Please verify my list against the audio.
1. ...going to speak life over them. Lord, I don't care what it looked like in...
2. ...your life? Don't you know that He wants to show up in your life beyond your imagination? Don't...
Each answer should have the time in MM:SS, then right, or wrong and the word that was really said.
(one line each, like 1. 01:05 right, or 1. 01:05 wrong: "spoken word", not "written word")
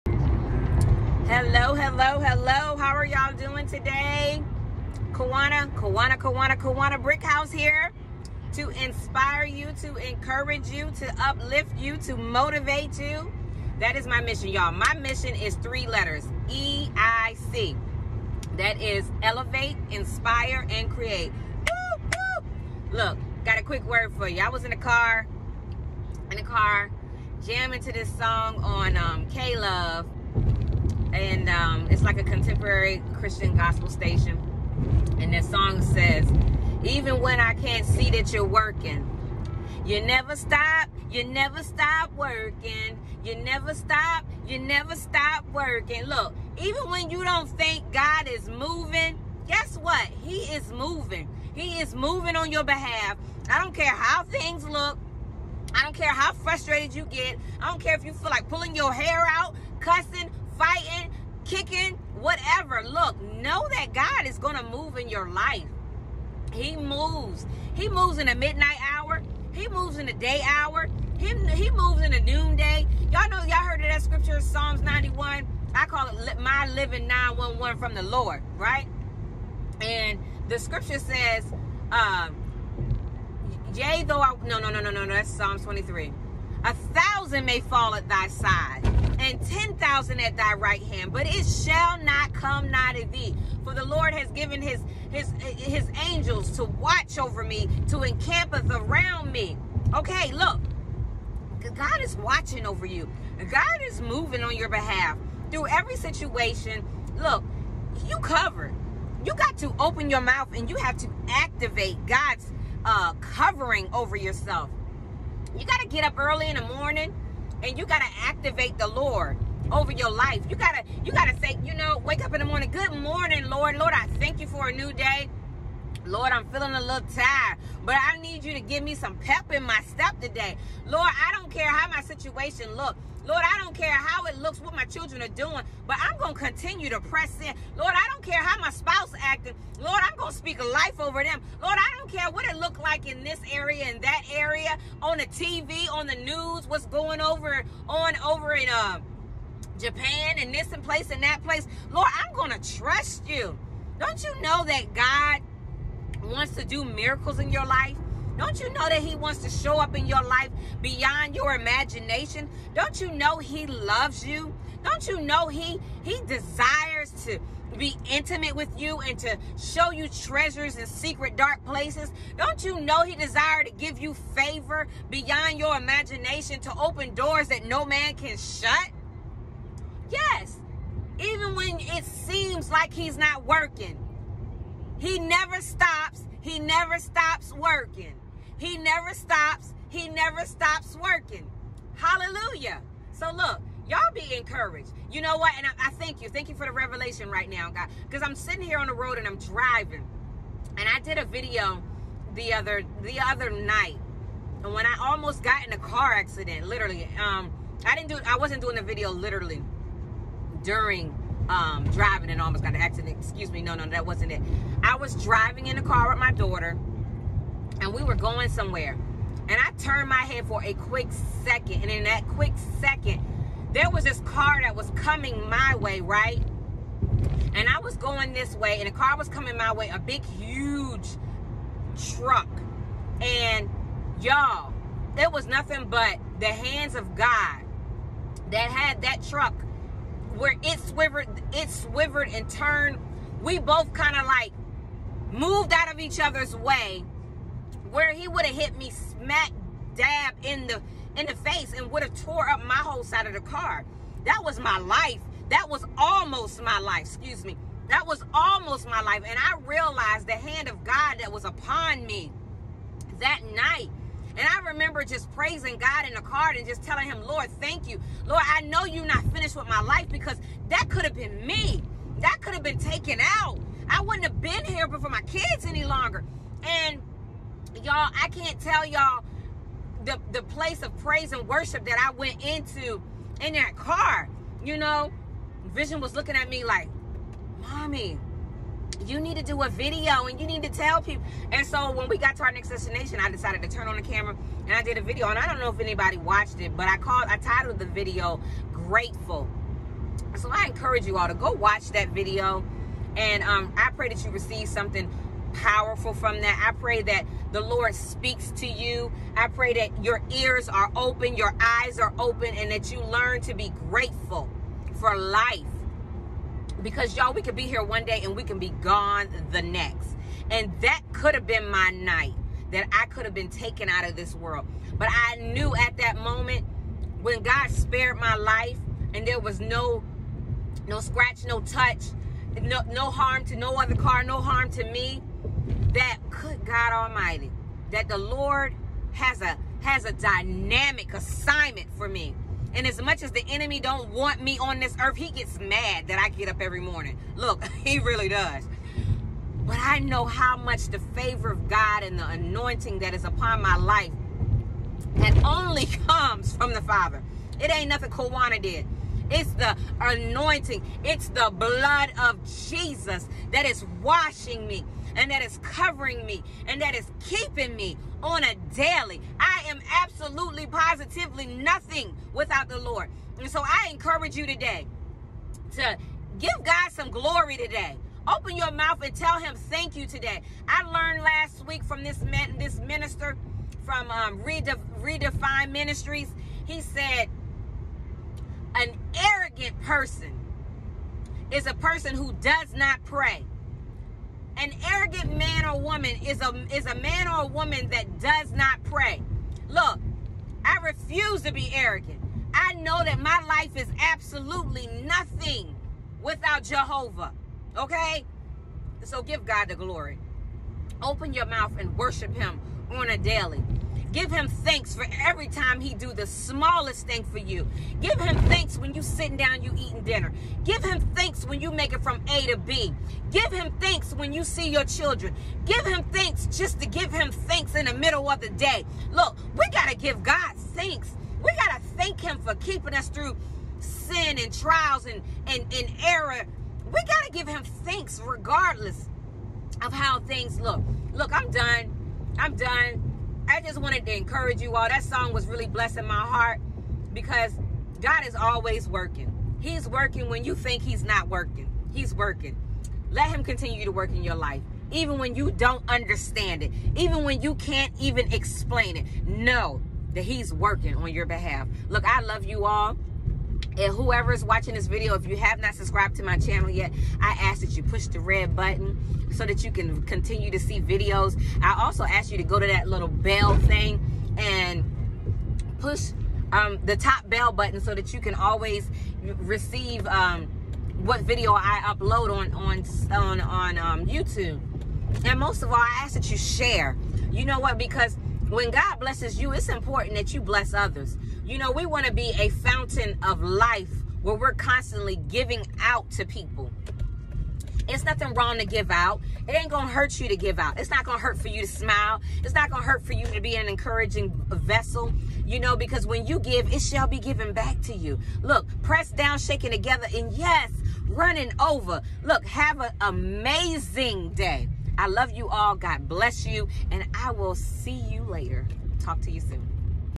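1. 02:20 right
2. 02:37 right.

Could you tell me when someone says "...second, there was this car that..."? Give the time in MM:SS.
03:42.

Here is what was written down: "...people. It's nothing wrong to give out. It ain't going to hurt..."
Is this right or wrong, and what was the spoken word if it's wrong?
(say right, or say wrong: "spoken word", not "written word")
right.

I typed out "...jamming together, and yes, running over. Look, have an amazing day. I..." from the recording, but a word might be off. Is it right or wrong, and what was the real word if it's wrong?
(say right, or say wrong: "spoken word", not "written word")
wrong: "shaking", not "jamming".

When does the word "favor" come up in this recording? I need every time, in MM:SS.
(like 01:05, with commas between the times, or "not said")
02:54, 05:51.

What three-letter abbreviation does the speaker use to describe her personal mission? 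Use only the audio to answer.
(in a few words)
EIC.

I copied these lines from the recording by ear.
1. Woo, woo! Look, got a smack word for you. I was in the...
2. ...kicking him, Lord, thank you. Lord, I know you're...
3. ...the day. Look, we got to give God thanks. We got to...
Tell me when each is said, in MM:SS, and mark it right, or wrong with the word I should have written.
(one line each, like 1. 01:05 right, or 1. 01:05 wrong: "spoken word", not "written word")
1. 00:21 wrong: "quick", not "smack"
2. 04:26 wrong: "telling", not "kicking"
3. 07:08 right.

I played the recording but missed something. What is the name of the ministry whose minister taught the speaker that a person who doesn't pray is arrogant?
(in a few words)
Redefine Ministries.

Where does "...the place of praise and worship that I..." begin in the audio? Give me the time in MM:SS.
04:40.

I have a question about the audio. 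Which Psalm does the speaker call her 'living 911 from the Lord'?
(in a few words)
Psalms 91.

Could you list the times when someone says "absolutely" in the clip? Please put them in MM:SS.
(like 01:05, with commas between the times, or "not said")
06:09, 06:43.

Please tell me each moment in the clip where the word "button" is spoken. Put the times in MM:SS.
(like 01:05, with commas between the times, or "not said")
07:48, 07:57.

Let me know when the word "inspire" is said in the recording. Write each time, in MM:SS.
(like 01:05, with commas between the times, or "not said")
00:08, 00:19.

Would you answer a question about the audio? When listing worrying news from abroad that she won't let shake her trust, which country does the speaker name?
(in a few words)
Japan.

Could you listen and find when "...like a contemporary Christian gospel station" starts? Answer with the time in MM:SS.
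00:32.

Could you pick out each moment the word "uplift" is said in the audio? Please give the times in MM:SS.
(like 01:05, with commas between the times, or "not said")
00:11.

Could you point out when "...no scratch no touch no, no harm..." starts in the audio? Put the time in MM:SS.
05:30.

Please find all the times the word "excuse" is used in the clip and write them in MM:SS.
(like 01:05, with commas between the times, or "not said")
03:33, 04:17.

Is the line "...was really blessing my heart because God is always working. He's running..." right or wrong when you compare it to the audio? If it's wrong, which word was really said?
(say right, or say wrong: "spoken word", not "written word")
wrong: "working", not "running".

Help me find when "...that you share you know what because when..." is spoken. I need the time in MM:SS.
08:06.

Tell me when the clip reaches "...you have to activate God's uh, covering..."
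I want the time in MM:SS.
01:50.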